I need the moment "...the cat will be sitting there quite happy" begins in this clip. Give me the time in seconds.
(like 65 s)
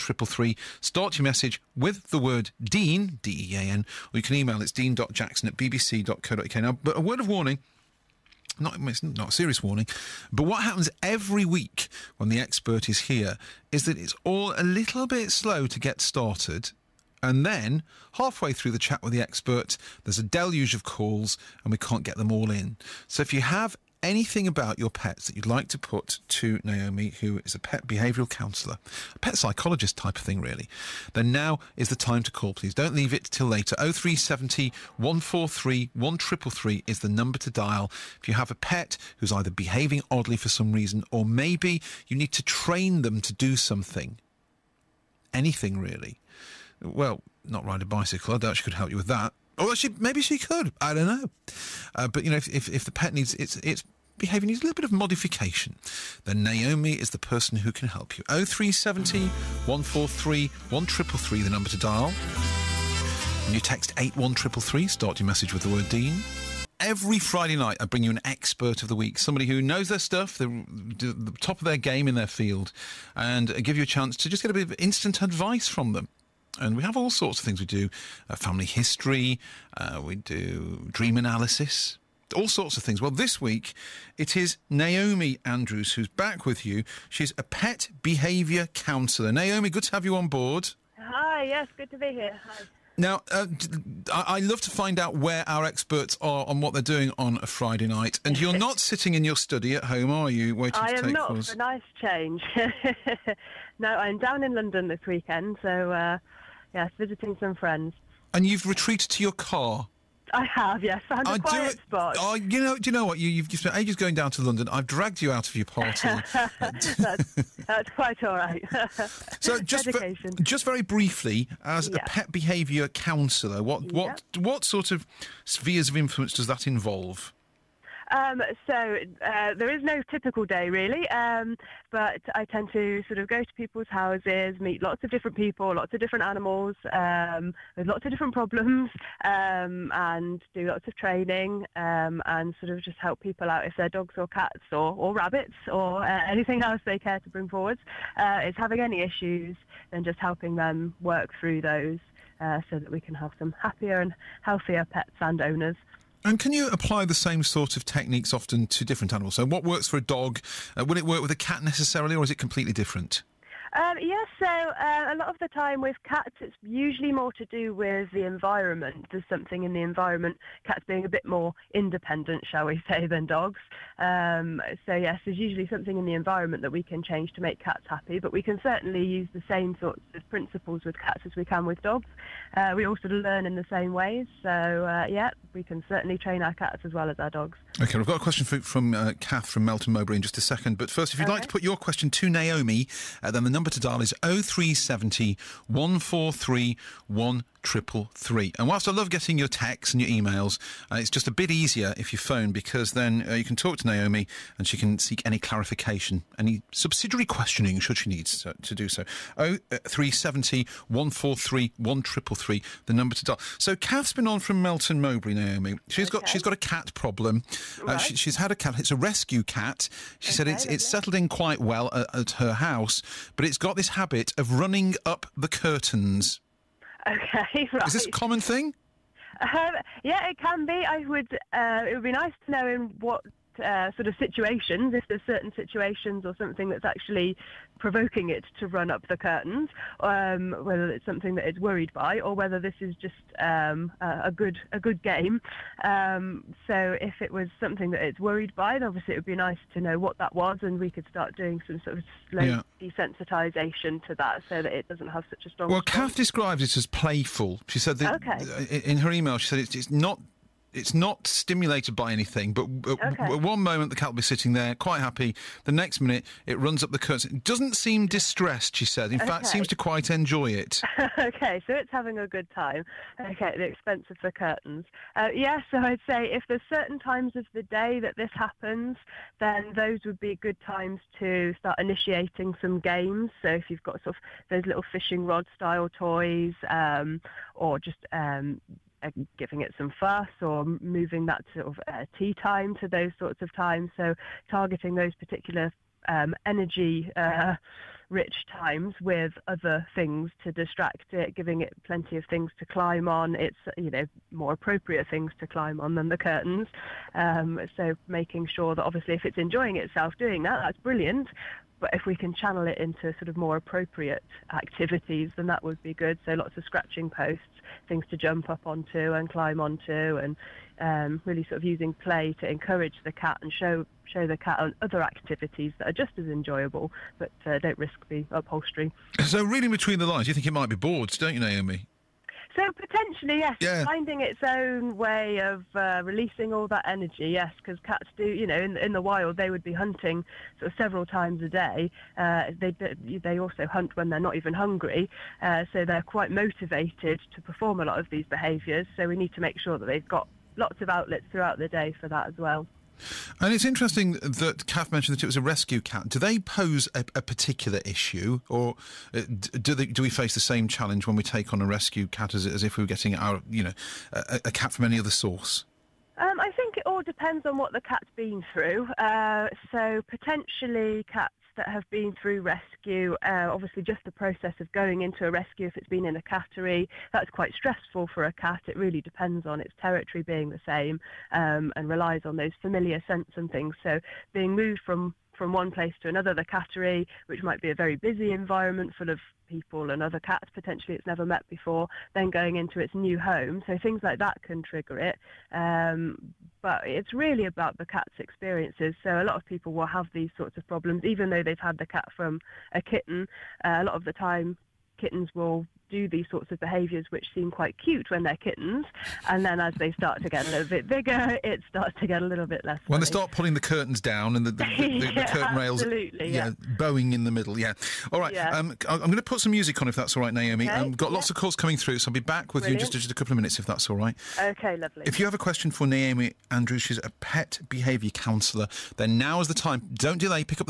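263 s.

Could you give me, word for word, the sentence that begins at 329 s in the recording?
So reading between the lines, you think it might be bored, don't you, Naomi?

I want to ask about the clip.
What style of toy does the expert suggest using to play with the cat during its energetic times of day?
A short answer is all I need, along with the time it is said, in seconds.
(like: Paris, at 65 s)
fishing rod style toys, at 284 s.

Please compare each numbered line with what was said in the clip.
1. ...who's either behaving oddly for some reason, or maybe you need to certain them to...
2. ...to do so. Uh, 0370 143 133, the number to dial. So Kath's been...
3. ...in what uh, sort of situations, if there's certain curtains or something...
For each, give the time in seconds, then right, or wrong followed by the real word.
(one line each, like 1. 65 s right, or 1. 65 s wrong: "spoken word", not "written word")
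1. 39 s wrong: "train", not "certain"
2. 208 s right
3. 232 s wrong: "situations", not "curtains".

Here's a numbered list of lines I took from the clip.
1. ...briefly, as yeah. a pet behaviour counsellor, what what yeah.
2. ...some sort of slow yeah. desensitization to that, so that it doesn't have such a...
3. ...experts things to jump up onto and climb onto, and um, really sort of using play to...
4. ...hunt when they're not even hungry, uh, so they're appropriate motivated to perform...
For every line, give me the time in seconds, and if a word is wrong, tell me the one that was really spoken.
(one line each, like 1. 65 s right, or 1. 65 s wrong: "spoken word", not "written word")
1. 120 s right
2. 251 s right
3. 317 s wrong: "posts", not "experts"
4. 343 s wrong: "quite", not "appropriate".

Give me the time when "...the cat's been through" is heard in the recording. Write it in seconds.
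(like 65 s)
367 s.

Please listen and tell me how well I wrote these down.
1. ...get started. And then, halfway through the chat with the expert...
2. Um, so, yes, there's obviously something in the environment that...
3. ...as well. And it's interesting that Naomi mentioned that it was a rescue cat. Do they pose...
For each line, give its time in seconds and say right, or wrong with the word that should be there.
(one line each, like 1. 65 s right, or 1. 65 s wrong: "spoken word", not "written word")
1. 15 s right
2. 173 s wrong: "usually", not "obviously"
3. 352 s wrong: "Kath", not "Naomi".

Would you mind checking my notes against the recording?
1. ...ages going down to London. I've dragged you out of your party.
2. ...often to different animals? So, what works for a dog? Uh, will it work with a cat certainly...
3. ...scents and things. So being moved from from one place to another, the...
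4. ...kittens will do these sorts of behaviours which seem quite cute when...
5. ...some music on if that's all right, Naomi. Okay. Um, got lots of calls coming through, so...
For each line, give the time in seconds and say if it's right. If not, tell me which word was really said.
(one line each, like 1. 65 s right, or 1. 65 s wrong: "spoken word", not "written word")
1. 113 s right
2. 158 s wrong: "necessarily", not "certainly"
3. 383 s right
4. 404 s right
5. 419 s right.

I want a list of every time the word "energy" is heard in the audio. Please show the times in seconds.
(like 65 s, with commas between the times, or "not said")
296 s, 336 s.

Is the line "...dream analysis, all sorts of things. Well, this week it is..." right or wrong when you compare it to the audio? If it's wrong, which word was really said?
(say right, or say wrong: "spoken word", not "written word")
right.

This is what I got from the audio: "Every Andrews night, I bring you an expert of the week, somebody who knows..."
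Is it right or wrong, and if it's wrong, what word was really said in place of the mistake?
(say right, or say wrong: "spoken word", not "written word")
wrong: "Friday", not "Andrews".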